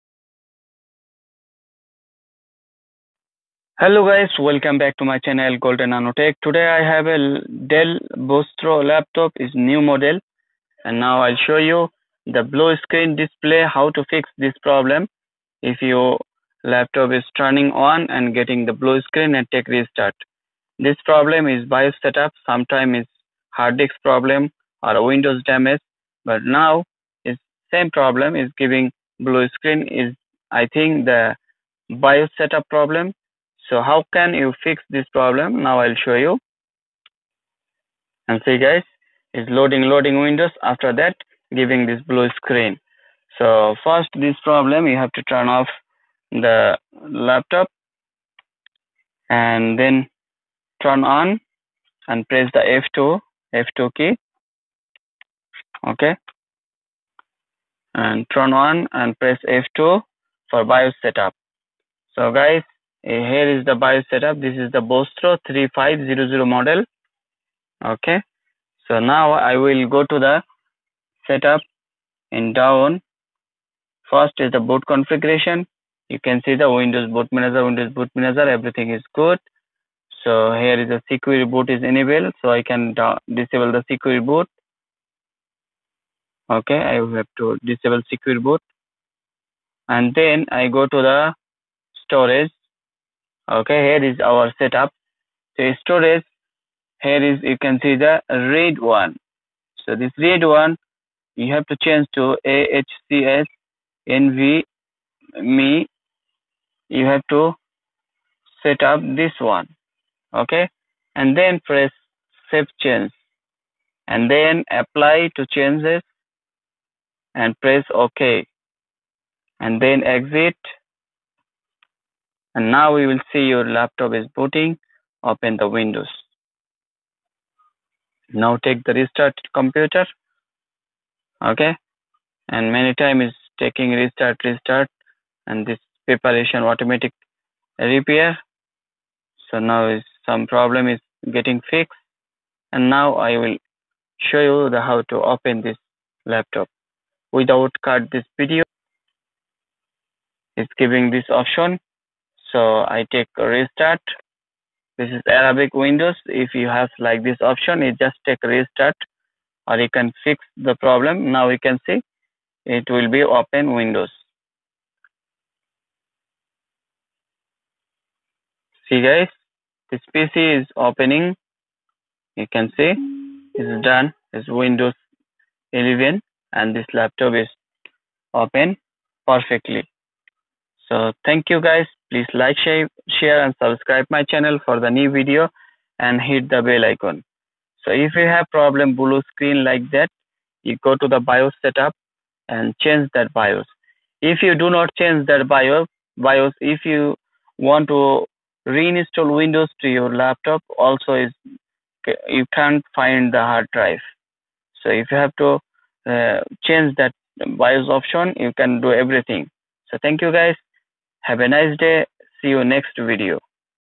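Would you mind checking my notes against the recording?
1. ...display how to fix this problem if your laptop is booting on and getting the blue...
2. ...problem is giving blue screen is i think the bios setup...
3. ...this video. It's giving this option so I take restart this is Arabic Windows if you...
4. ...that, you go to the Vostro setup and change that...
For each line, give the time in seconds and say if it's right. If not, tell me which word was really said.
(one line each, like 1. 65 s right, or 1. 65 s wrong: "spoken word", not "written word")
1. 13 s wrong: "turning", not "booting"
2. 27 s right
3. 148 s right
4. 189 s wrong: "BIOS", not "Vostro".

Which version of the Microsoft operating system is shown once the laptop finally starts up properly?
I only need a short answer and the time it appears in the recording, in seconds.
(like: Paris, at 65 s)
Windows 11, at 174 s.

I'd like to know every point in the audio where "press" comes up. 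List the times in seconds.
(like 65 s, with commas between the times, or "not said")
52 s, 59 s, 111 s, 117 s.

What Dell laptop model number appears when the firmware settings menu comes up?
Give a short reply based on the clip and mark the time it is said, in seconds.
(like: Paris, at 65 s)
Vostro 3500, at 64 s.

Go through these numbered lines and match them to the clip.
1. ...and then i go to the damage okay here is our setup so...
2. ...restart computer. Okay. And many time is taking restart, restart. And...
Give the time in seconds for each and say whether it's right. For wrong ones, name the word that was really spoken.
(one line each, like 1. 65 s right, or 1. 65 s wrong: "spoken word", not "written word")
1. 89 s wrong: "storage", not "damage"
2. 128 s right.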